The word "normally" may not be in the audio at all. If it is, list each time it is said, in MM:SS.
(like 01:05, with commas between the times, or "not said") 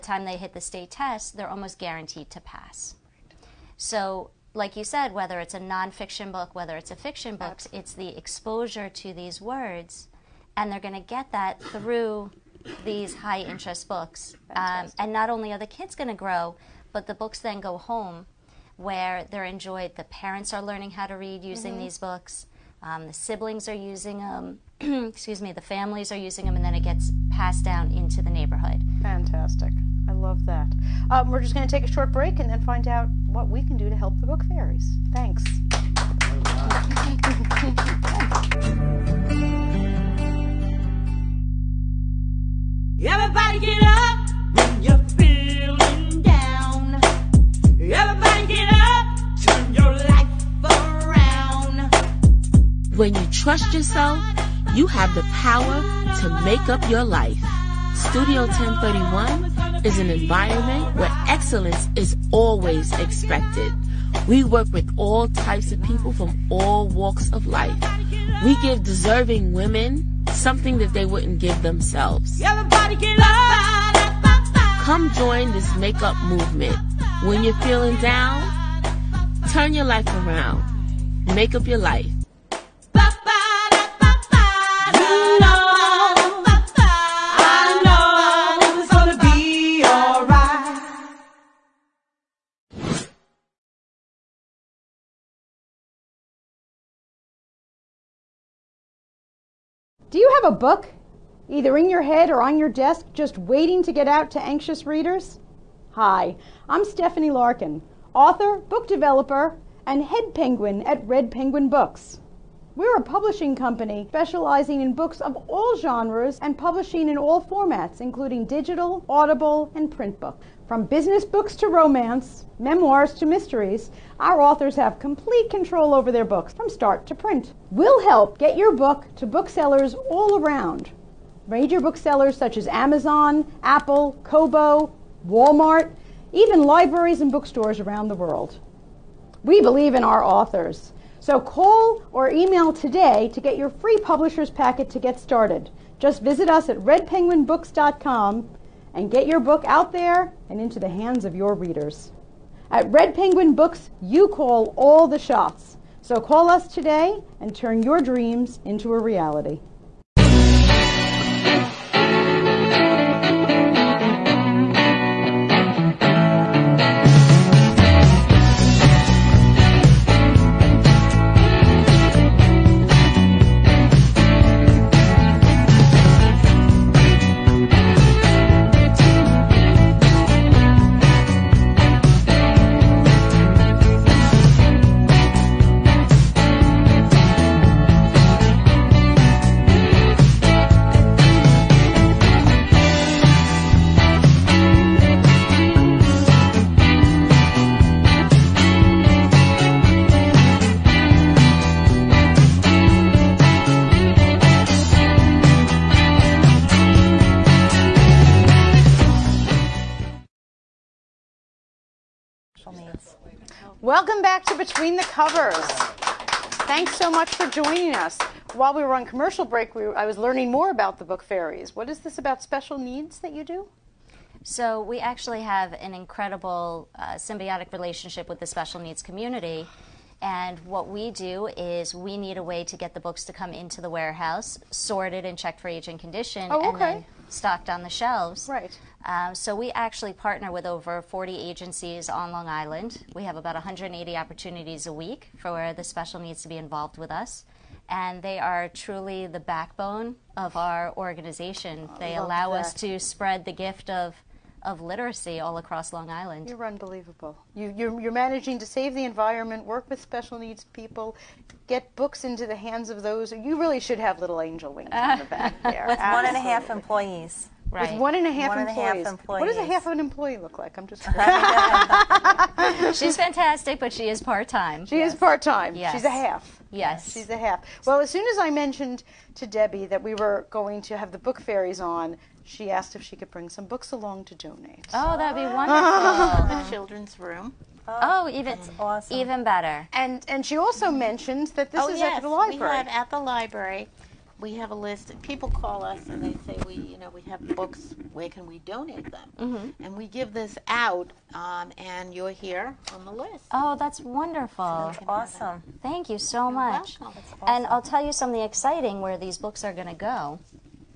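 not said.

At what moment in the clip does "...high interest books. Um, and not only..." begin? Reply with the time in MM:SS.
00:13.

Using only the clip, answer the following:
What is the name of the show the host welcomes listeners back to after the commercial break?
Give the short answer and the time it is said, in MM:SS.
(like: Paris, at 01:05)
Between the Covers, at 03:34.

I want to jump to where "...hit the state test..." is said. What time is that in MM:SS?
00:00.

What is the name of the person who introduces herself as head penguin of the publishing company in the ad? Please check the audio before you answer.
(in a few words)
Stephanie Larkin.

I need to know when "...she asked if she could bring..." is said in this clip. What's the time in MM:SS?
04:42.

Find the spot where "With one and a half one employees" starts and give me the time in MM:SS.
04:27.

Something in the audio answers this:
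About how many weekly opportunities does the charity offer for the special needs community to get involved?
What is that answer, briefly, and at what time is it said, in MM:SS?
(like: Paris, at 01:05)
180, at 04:03.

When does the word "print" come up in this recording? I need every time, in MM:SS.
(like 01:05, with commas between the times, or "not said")
01:59, 02:07.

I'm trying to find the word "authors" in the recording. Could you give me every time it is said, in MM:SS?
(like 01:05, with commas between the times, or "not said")
01:48, 02:04, 02:20.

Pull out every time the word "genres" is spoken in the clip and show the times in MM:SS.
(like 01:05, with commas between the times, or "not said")
01:55.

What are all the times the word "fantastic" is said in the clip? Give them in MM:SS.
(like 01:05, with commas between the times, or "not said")
00:29, 04:33.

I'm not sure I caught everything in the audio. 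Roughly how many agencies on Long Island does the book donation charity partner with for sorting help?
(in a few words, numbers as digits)
over 40.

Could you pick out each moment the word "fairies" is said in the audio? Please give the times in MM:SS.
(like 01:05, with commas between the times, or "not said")
00:34, 03:41, 04:41.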